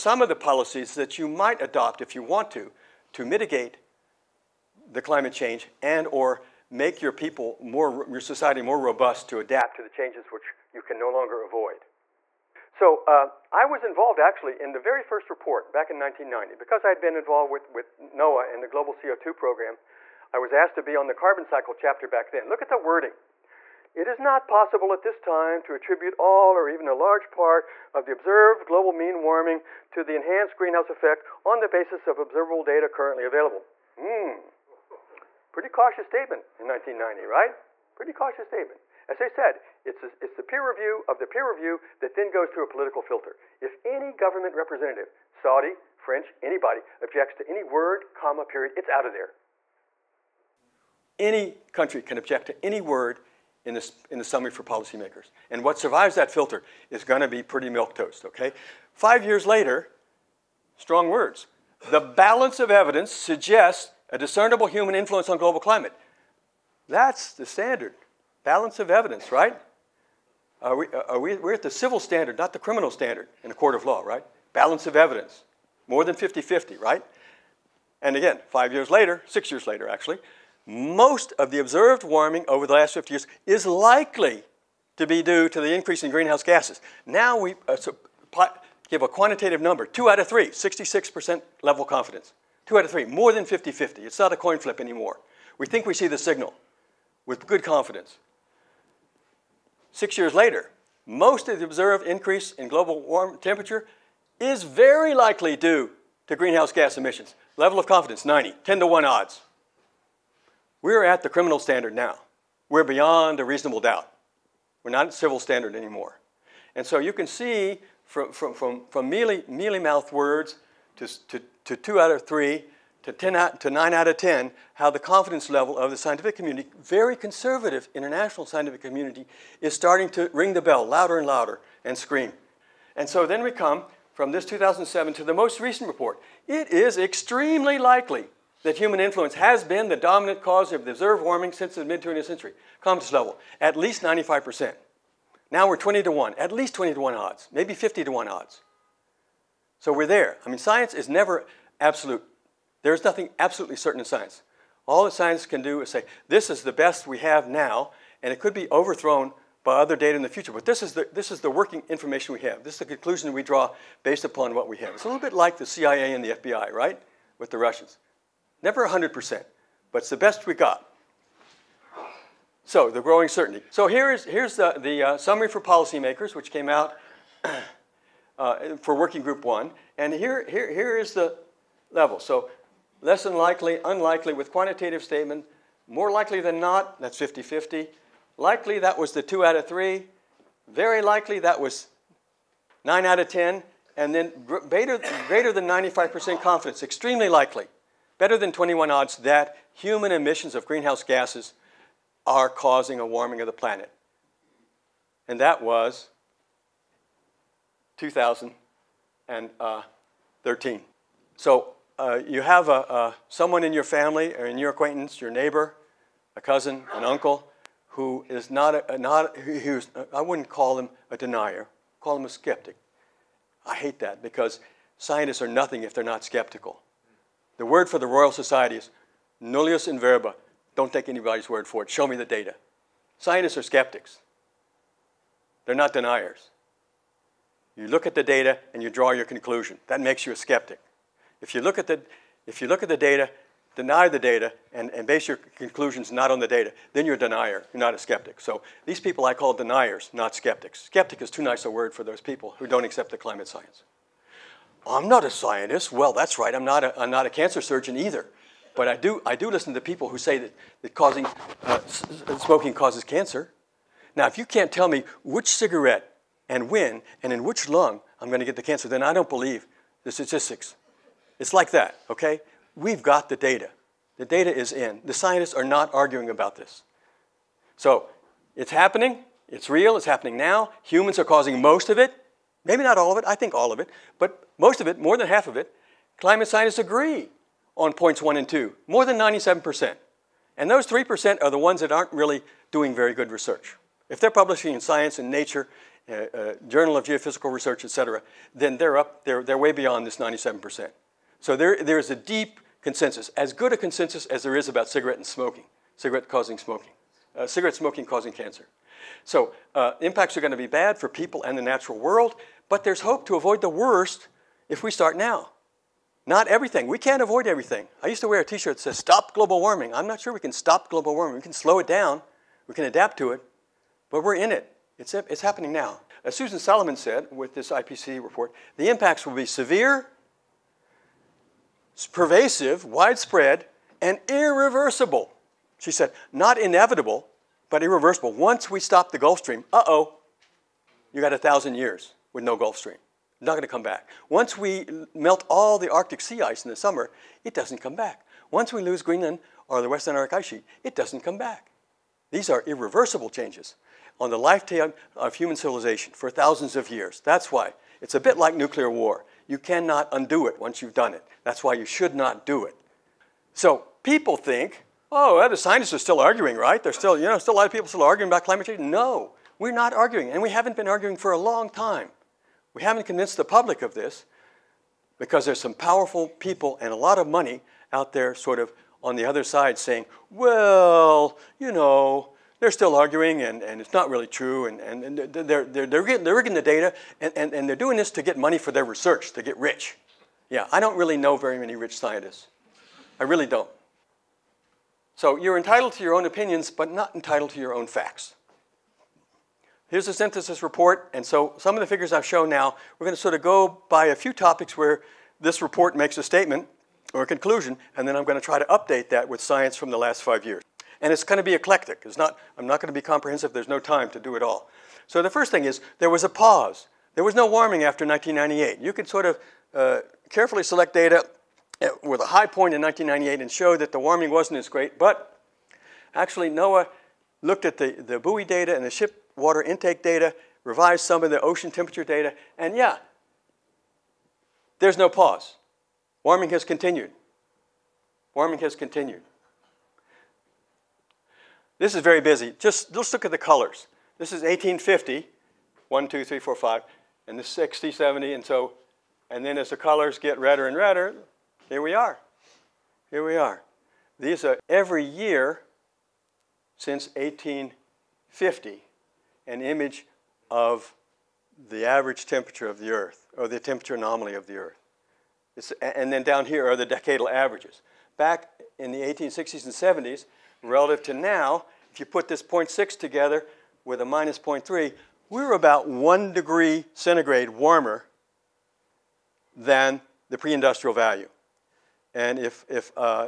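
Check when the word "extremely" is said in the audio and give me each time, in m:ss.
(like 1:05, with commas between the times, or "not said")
2:16, 3:16.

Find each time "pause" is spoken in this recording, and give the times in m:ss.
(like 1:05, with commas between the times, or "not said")
6:56, 7:15.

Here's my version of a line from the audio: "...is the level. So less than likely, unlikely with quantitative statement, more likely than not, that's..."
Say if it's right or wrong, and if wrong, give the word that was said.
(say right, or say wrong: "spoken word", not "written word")
right.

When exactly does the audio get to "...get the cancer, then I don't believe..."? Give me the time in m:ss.
4:28.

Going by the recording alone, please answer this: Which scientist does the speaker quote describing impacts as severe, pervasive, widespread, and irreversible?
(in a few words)
Susan Solomon.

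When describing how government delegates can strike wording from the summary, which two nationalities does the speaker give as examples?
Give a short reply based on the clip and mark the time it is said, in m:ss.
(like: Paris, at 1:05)
Saudi, French, at 0:45.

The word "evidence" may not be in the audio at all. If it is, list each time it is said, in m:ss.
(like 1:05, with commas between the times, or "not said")
1:02, 1:08, 1:14.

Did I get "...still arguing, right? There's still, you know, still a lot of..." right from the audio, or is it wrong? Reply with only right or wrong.
right.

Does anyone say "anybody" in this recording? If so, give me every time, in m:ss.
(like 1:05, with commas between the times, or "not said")
0:46, 3:51.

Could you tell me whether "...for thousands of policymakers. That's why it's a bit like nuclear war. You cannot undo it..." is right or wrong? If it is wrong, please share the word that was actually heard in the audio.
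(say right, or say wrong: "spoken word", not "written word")
wrong: "years", not "policymakers".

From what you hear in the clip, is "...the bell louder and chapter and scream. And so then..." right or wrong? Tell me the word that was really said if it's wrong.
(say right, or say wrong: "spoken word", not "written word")
wrong: "louder", not "chapter".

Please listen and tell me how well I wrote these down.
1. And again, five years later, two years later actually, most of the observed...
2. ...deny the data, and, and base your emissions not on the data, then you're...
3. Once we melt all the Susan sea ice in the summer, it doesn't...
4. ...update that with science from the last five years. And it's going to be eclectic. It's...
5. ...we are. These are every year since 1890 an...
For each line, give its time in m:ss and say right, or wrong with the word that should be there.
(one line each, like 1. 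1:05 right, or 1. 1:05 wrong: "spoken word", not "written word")
1. 1:18 wrong: "six", not "two"
2. 4:03 wrong: "conclusions", not "emissions"
3. 5:44 wrong: "Arctic", not "Susan"
4. 6:48 right
5. 7:33 wrong: "1850", not "1890".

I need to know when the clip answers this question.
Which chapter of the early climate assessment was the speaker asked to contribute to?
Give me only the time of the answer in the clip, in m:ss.
0:21.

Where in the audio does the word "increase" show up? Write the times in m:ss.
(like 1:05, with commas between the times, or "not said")
1:25, 1:42.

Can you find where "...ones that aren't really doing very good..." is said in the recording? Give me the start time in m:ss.
4:51.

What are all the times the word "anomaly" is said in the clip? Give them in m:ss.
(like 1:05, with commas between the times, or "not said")
7:43.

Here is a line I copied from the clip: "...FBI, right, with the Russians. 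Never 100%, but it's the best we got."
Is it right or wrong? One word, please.
right.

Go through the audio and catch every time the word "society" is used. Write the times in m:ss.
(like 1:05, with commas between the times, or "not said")
0:08, 3:48.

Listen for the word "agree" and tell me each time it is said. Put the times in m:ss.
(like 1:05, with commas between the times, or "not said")
4:46.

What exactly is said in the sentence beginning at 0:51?
Any country can object to any word in, this, in the summary for policymakers.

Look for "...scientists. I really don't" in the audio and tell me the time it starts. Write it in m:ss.
6:31.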